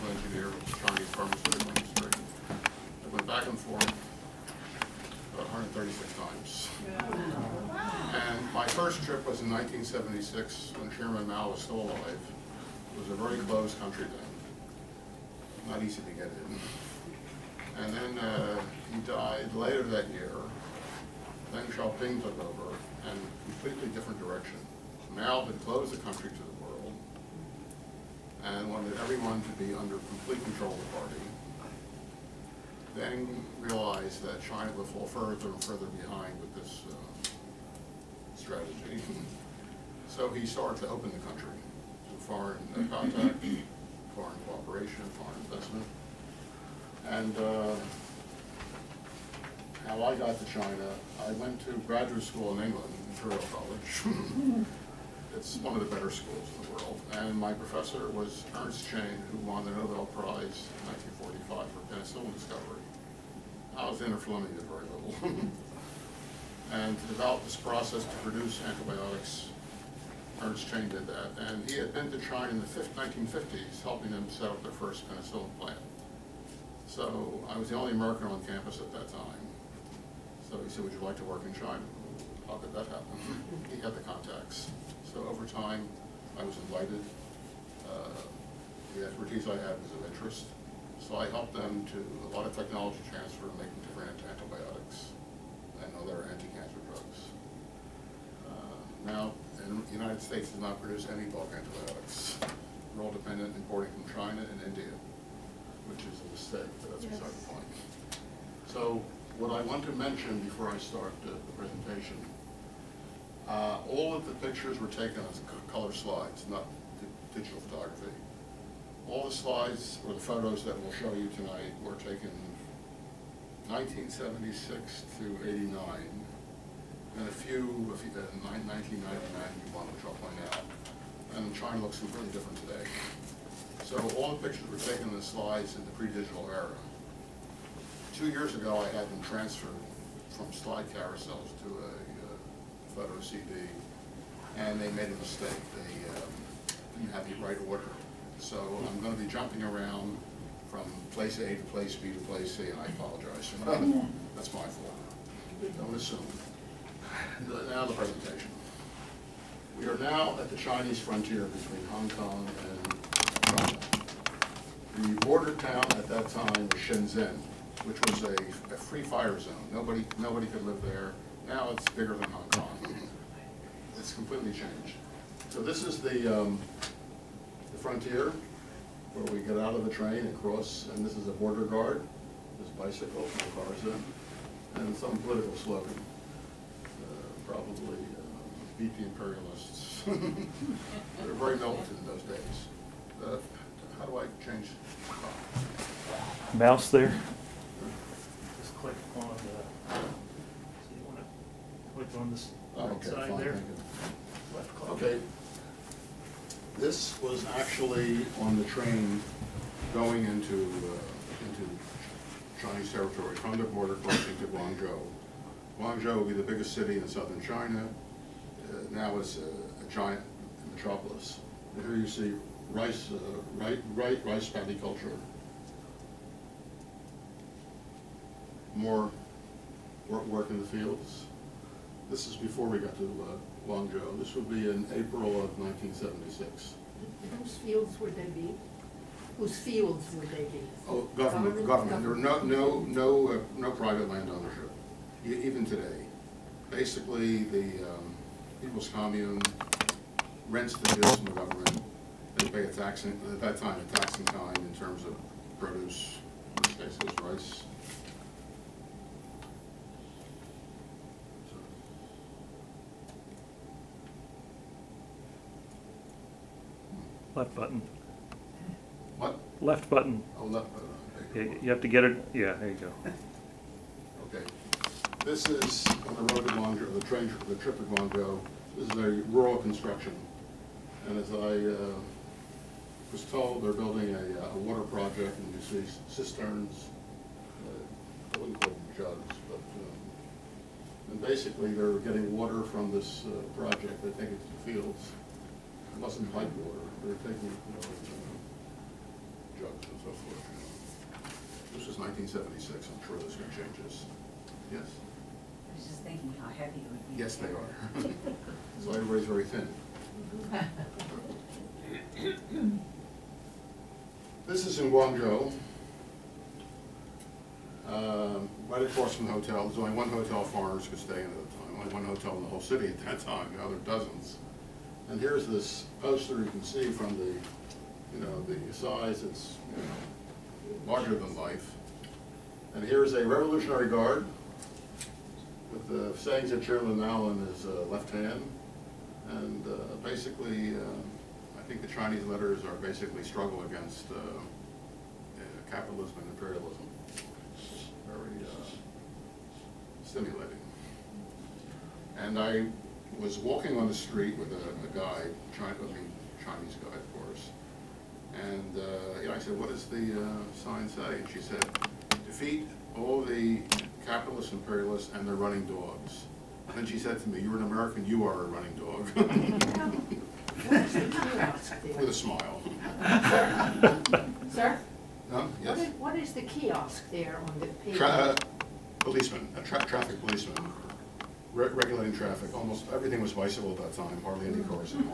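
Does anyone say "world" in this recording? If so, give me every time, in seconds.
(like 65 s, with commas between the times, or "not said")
26 s, 56 s.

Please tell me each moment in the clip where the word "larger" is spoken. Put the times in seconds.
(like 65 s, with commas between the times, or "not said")
330 s.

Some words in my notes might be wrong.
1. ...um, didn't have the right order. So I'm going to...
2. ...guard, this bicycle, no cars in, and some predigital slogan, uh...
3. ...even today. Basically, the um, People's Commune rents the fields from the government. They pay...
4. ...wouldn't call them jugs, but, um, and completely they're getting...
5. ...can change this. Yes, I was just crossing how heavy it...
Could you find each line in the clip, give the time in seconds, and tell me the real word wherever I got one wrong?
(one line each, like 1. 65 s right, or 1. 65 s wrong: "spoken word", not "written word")
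1. 146 s right
2. 181 s wrong: "political", not "predigital"
3. 245 s right
4. 288 s wrong: "basically", not "completely"
5. 303 s wrong: "thinking", not "crossing".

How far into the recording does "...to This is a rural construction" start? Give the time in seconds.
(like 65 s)
277 s.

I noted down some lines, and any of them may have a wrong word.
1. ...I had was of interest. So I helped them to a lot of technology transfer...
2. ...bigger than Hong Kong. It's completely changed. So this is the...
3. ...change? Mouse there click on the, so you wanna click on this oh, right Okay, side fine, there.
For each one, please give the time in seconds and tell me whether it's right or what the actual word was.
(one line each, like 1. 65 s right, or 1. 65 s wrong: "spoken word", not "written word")
1. 89 s right
2. 171 s right
3. 194 s right.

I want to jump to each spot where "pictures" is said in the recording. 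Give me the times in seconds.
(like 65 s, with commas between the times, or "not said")
114 s, 134 s.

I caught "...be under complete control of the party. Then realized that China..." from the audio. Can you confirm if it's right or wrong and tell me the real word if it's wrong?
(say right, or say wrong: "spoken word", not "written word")
right.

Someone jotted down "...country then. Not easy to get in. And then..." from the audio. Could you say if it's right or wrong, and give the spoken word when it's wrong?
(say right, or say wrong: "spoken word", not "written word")
right.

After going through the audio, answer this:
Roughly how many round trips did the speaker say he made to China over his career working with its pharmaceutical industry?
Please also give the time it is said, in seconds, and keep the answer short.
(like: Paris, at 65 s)
136, at 5 s.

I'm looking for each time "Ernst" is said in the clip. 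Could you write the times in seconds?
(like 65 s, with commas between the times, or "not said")
58 s, 70 s.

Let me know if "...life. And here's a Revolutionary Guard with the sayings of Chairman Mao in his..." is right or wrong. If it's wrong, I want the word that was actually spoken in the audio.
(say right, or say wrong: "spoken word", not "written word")
right.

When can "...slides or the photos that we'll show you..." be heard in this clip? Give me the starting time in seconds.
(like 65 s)
119 s.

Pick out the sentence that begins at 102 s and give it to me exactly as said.
We're all dependent importing from China and India, which is a mistake that's yes.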